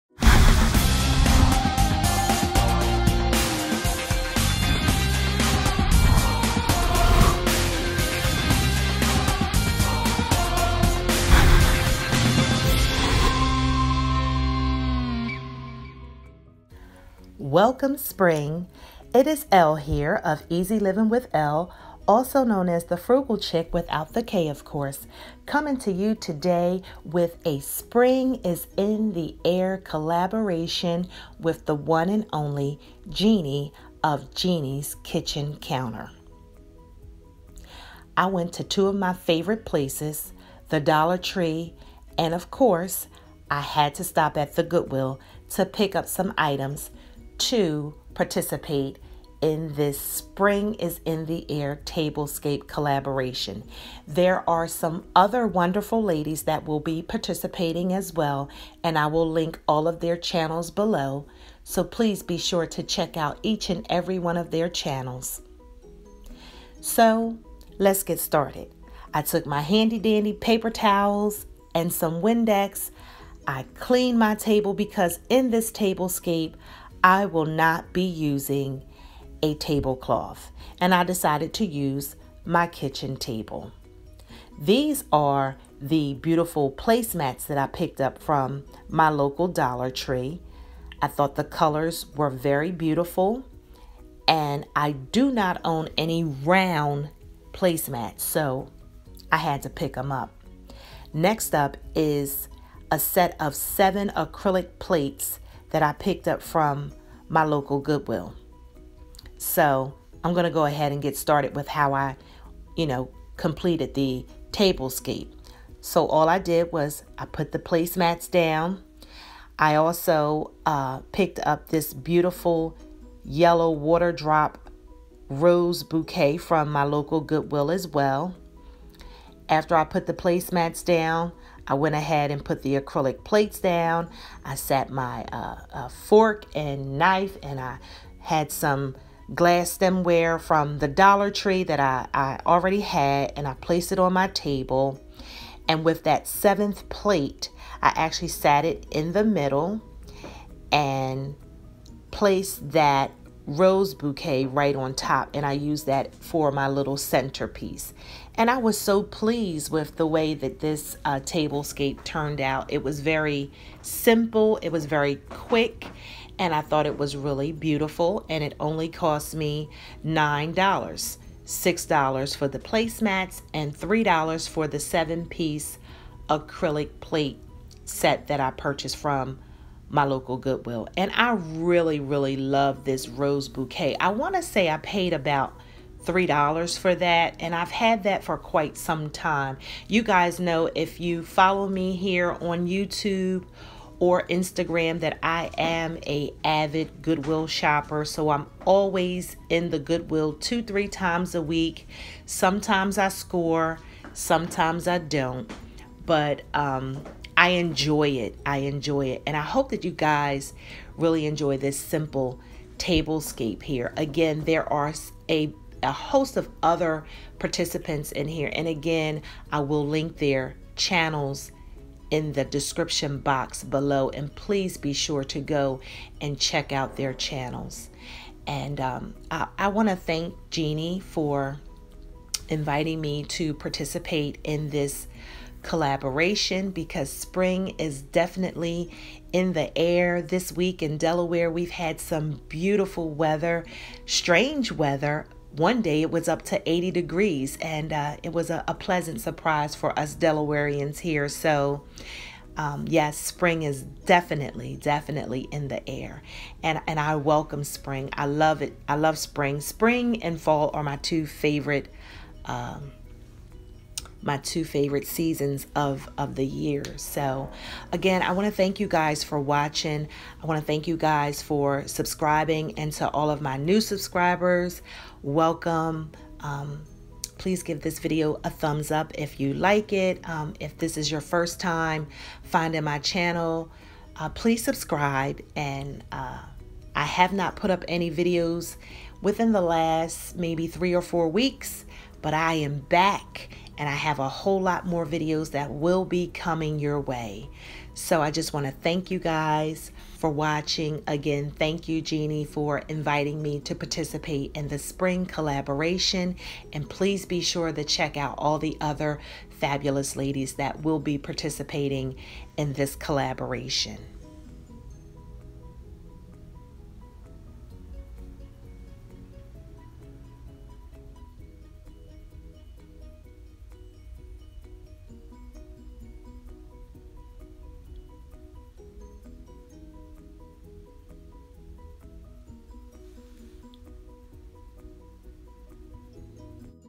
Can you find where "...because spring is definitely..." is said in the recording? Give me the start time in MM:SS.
03:56.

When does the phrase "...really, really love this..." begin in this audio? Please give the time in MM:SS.
03:01.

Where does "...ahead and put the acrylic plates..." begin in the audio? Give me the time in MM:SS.
02:11.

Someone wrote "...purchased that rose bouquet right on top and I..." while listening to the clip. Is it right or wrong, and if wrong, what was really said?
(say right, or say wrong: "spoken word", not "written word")
wrong: "placed", not "purchased".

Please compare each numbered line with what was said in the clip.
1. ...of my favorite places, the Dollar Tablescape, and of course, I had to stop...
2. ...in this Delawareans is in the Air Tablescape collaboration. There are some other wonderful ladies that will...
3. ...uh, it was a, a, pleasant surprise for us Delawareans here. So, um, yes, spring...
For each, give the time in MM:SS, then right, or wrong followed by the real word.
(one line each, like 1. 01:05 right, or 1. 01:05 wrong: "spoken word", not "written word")
1. 00:38 wrong: "Tree", not "Tablescape"
2. 00:49 wrong: "Spring", not "Delawareans"
3. 04:07 right.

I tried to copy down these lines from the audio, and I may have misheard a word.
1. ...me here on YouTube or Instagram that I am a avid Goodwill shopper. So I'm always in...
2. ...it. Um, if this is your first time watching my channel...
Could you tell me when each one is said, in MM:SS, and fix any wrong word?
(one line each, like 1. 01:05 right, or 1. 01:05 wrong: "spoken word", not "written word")
1. 03:11 right
2. 04:39 wrong: "finding", not "watching".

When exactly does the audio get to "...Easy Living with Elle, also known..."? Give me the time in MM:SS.
00:20.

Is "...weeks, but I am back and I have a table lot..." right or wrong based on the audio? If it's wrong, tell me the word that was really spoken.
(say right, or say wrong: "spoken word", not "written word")
wrong: "whole", not "table".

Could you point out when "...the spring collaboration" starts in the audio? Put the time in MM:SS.
05:04.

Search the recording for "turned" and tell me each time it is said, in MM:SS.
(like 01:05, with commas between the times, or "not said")
02:42.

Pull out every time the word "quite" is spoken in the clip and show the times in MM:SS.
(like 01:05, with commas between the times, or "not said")
03:08.